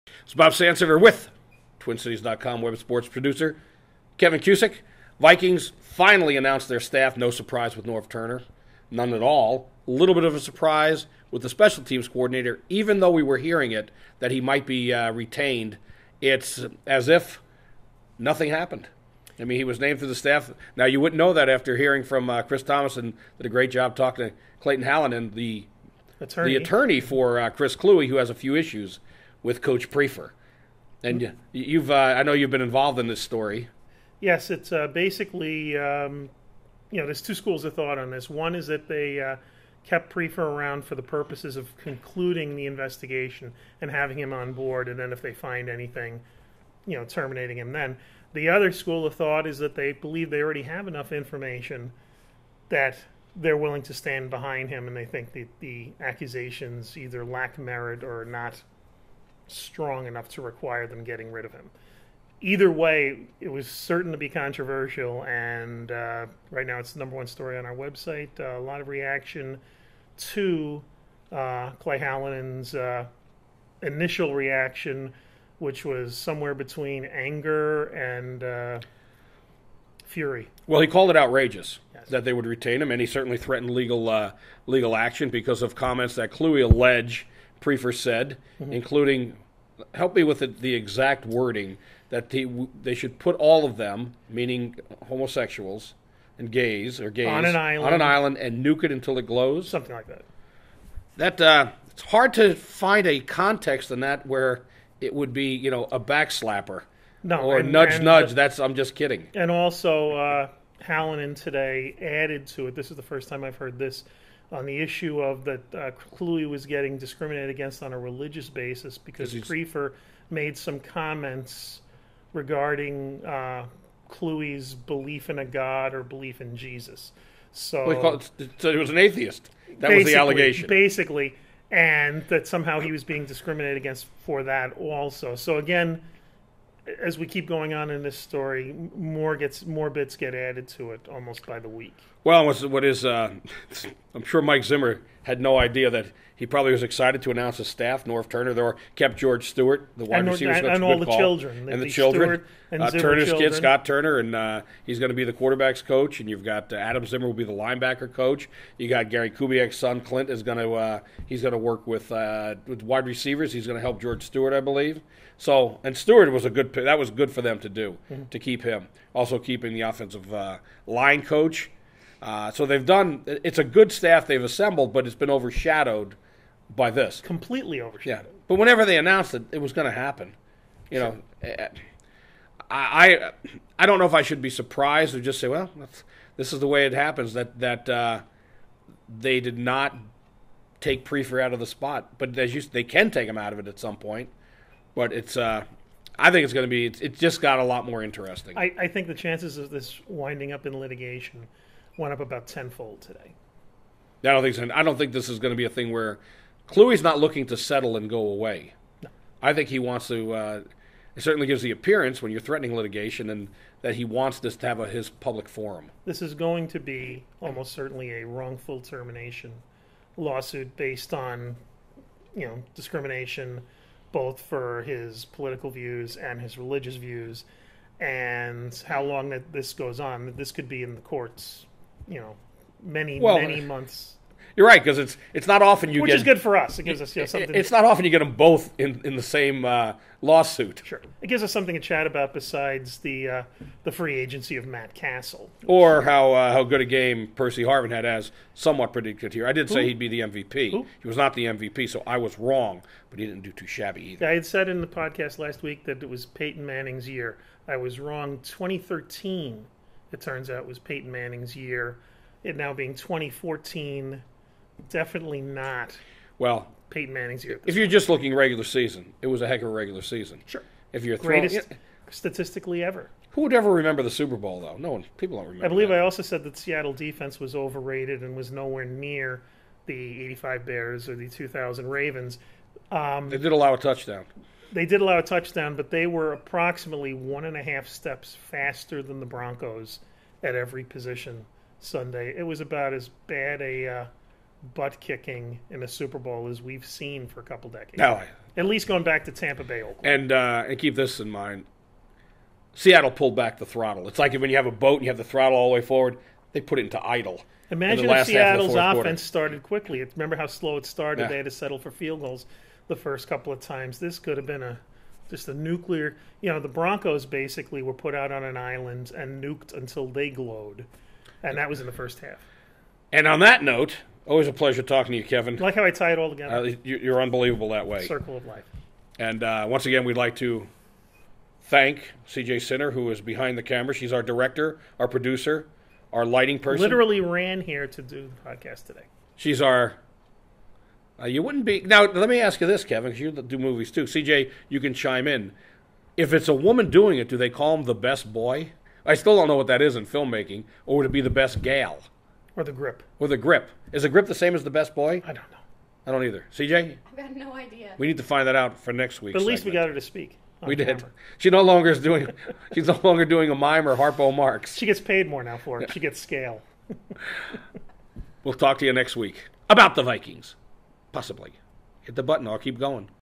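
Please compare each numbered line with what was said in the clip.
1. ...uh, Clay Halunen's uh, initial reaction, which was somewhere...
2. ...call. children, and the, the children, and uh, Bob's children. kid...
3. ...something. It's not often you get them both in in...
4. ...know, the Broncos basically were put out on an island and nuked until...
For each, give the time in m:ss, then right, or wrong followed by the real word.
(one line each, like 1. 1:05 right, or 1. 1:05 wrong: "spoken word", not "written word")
1. 1:11 right
2. 2:31 wrong: "Turner", not "Bob"
3. 3:57 right
4. 5:16 right.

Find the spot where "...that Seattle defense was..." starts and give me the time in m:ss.
4:36.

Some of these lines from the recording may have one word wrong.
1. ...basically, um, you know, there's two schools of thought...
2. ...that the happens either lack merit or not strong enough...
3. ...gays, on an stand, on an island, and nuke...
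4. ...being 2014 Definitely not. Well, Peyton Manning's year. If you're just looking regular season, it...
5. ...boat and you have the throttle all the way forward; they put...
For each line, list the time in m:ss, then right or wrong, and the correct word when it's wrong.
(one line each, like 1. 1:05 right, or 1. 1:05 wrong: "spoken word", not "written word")
1. 0:34 right
2. 0:55 wrong: "accusations", not "happens"
3. 1:37 wrong: "island", not "stand"
4. 4:22 right
5. 5:04 right.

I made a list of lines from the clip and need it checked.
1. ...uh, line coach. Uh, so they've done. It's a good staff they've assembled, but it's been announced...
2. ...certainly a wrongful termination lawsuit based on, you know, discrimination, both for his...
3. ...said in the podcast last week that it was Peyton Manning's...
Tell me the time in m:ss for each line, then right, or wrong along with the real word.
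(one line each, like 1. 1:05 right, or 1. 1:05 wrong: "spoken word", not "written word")
1. 2:50 wrong: "overshadowed", not "announced"
2. 3:37 right
3. 4:14 right.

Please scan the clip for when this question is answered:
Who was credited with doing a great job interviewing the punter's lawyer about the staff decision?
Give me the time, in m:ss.
0:22.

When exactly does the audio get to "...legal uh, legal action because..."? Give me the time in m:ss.
1:23.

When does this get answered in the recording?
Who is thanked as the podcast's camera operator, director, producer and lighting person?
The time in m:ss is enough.
5:32.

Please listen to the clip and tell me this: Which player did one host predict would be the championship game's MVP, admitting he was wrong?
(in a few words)
Percy Harvin.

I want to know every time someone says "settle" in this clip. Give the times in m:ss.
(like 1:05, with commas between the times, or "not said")
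3:27, 5:11.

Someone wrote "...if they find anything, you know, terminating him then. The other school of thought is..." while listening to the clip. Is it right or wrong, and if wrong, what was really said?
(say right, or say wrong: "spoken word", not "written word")
right.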